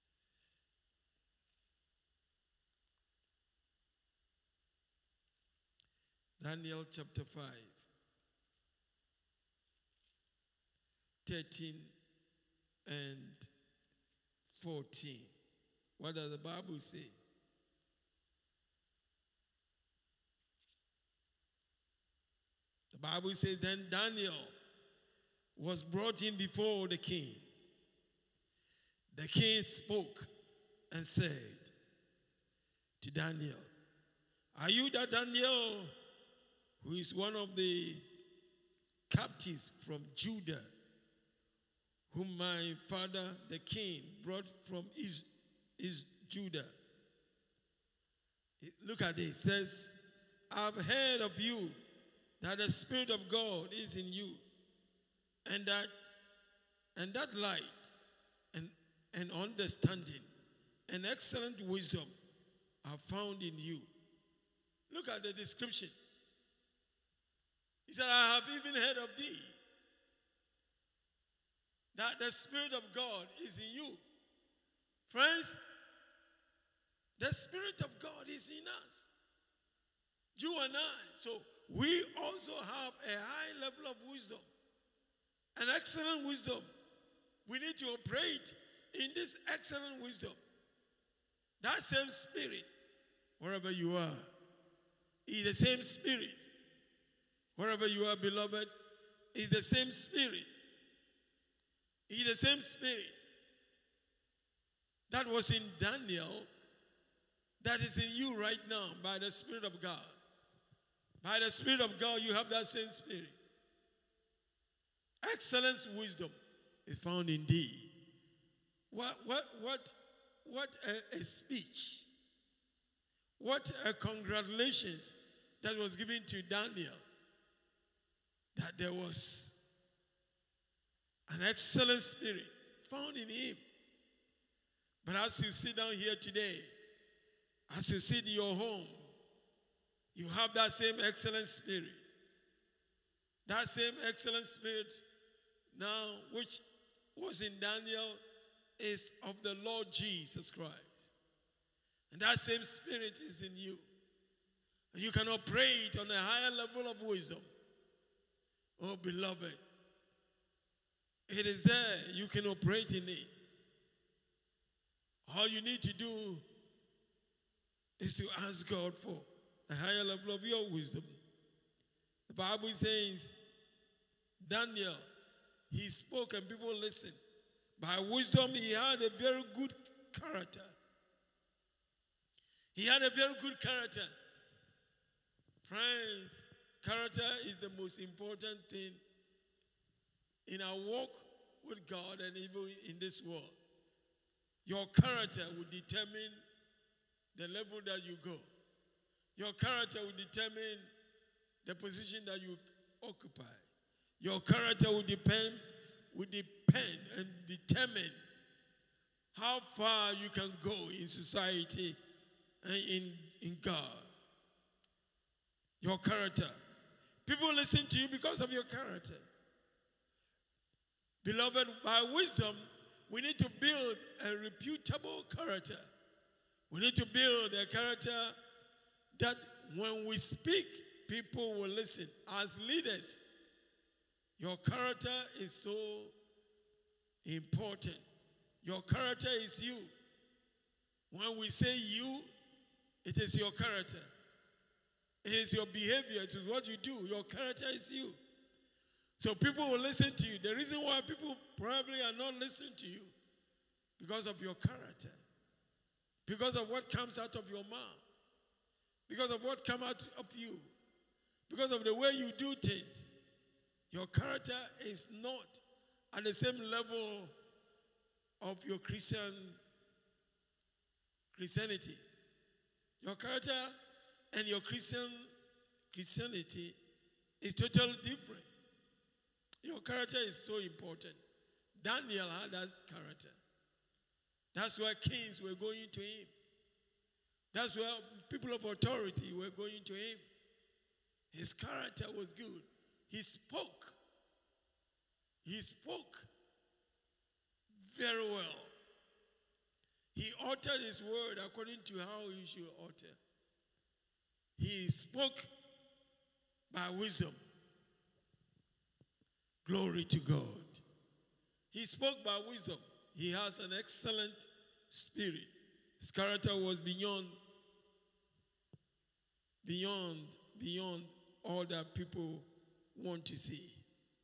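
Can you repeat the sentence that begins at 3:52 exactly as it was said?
As leaders, your character is so important.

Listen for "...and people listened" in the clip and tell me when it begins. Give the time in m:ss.
2:56.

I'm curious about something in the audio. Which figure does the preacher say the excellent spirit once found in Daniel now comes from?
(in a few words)
Lord Jesus Christ.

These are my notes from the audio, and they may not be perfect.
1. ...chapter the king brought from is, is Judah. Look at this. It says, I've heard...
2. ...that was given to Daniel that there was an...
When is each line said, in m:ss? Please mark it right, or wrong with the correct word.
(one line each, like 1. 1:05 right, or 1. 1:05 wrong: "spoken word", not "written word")
1. 0:42 wrong: "father", not "chapter"
2. 2:05 right.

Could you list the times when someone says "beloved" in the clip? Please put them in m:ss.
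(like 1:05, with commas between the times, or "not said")
1:38, 2:39, 3:41.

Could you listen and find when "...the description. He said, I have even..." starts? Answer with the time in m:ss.
1:05.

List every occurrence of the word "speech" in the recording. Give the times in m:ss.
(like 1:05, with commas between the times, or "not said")
2:01.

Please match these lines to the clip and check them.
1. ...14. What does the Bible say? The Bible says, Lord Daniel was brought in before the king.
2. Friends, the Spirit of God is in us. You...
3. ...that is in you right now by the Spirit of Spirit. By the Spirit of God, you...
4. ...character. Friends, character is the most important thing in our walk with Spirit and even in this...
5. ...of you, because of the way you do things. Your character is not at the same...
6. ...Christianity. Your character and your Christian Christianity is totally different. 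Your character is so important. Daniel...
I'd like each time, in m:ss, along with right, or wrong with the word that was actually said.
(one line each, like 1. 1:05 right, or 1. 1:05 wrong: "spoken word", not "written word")
1. 0:14 wrong: "Then", not "Lord"
2. 1:15 right
3. 1:47 wrong: "God", not "Spirit"
4. 3:03 wrong: "God", not "Spirit"
5. 4:20 right
6. 4:31 right.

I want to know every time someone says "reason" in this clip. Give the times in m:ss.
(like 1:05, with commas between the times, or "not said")
4:10.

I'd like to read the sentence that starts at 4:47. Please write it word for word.
That's where people of authority were going to him.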